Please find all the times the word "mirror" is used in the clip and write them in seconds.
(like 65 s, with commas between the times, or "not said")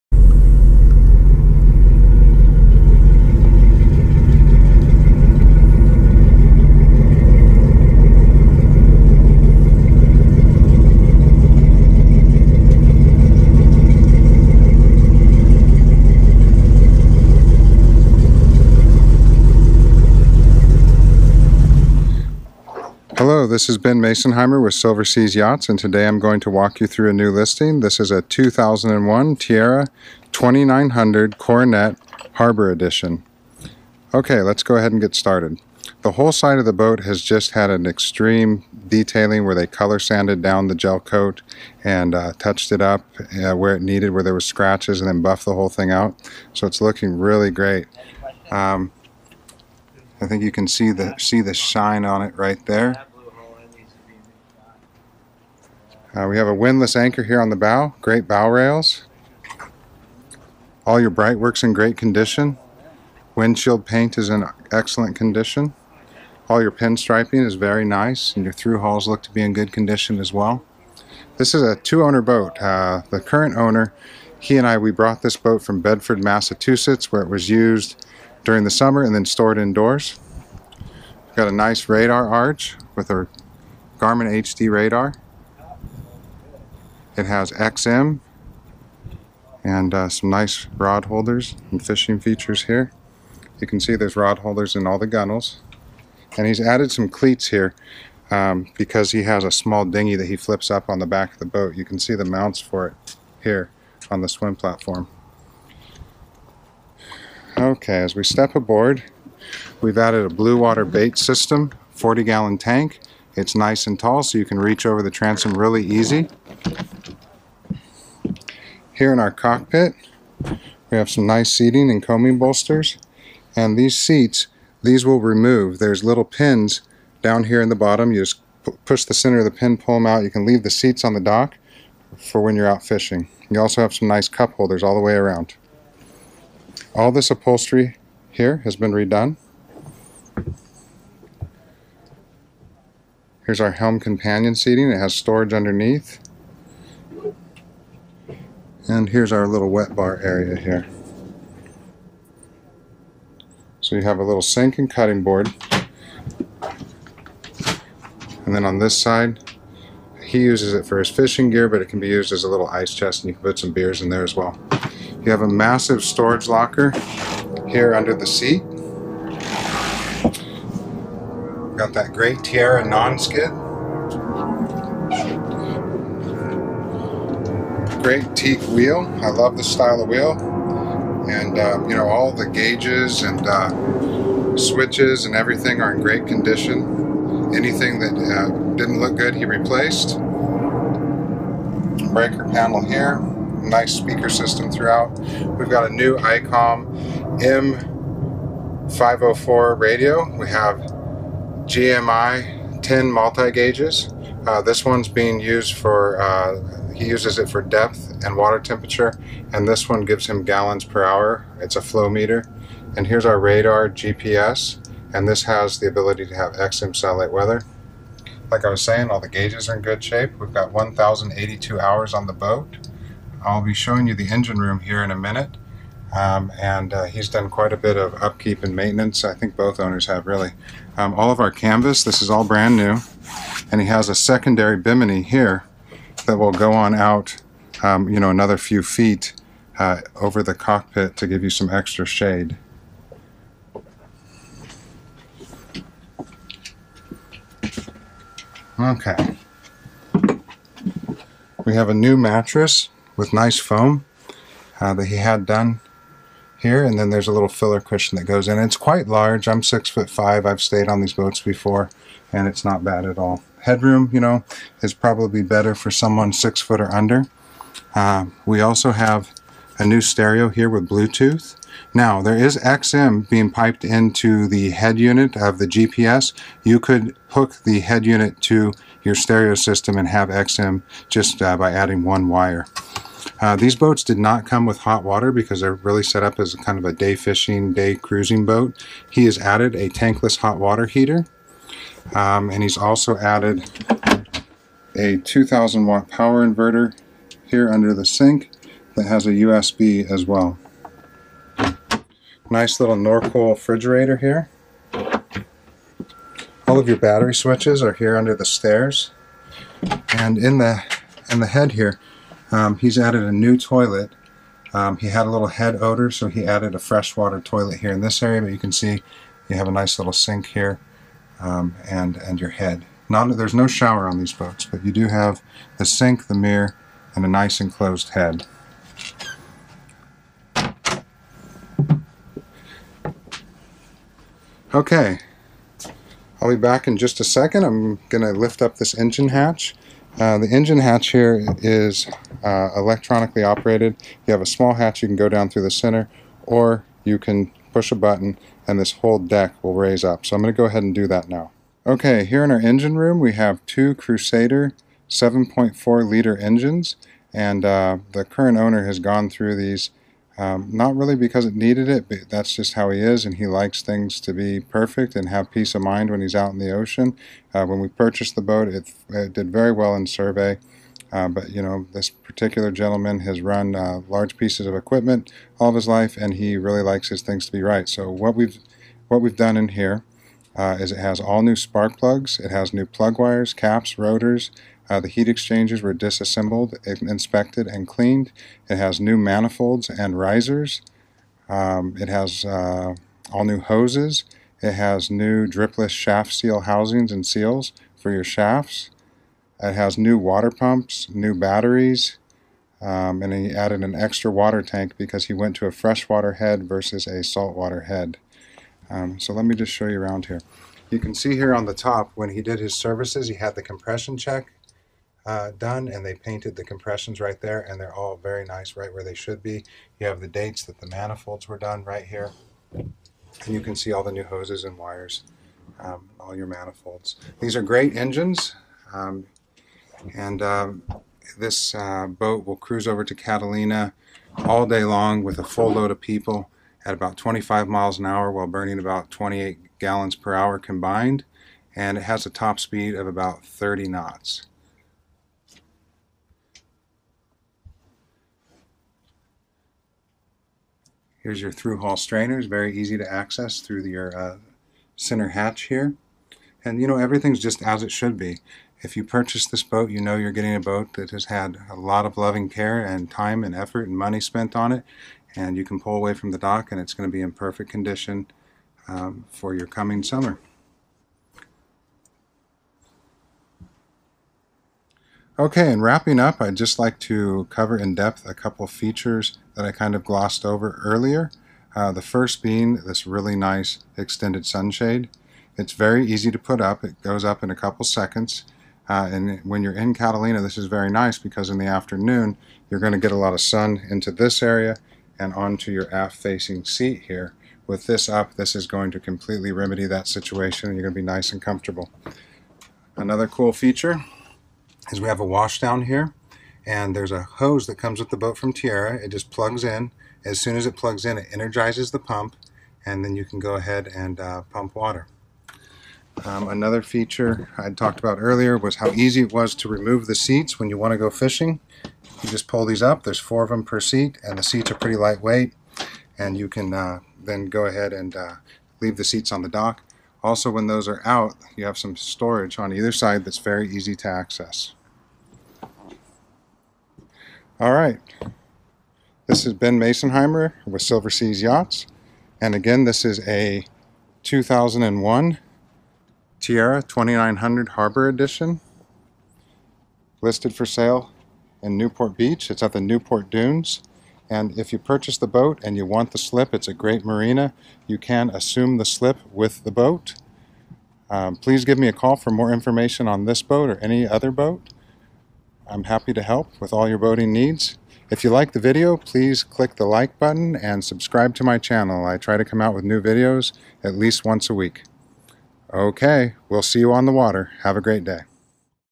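326 s.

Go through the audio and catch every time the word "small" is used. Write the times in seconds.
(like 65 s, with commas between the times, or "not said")
99 s, 344 s.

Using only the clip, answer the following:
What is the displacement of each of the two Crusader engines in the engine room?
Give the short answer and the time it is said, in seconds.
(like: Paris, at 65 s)
7.4 liters, at 355 s.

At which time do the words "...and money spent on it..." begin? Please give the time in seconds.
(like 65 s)
463 s.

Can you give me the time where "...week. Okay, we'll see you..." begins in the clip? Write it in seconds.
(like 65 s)
574 s.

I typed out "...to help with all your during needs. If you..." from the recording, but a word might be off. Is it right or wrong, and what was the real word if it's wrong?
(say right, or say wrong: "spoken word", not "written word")
wrong: "boating", not "during".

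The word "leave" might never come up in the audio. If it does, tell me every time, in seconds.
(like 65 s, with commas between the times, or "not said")
130 s, 528 s.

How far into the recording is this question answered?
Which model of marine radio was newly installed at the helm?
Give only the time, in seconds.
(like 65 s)
196 s.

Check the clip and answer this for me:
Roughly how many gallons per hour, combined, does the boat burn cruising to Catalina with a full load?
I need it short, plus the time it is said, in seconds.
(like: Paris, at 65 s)
28, at 439 s.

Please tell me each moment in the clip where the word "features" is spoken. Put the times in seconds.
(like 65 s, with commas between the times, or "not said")
92 s, 478 s, 503 s, 516 s.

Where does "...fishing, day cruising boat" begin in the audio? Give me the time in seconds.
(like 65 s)
287 s.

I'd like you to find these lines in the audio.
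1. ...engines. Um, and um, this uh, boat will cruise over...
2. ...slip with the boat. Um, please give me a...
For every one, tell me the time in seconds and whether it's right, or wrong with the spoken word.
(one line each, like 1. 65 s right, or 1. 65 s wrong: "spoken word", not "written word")
1. 427 s right
2. 558 s right.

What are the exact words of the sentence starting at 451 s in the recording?
Here's your through-hull strainers, very easy to access through your uh, center hatch here.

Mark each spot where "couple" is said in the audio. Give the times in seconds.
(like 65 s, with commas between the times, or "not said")
478 s, 487 s.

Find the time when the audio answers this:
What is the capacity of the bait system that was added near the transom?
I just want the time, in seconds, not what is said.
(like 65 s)
111 s.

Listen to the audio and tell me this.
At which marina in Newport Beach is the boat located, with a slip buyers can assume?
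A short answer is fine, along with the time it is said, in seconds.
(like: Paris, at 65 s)
Newport Dunes, at 552 s.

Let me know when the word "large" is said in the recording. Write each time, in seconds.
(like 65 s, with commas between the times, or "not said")
259 s, 374 s.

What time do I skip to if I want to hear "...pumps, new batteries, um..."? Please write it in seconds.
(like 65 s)
400 s.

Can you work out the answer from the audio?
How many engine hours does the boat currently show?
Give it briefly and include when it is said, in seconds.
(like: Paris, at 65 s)
1,082, at 220 s.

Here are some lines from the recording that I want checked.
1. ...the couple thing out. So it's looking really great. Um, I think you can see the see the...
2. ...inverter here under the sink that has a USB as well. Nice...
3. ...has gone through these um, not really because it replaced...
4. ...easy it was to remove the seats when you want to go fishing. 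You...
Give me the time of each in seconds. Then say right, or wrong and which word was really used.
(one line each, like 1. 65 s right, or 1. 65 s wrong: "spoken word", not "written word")
1. 45 s wrong: "whole", not "couple"
2. 296 s right
3. 358 s wrong: "needed", not "replaced"
4. 518 s right.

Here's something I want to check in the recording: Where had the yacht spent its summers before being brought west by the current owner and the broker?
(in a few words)
Bedford, Massachusetts.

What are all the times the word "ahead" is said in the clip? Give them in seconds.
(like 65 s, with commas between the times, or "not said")
34 s, 350 s, 513 s, 527 s.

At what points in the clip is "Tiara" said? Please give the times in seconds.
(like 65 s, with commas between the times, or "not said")
29 s, 172 s, 508 s, 546 s.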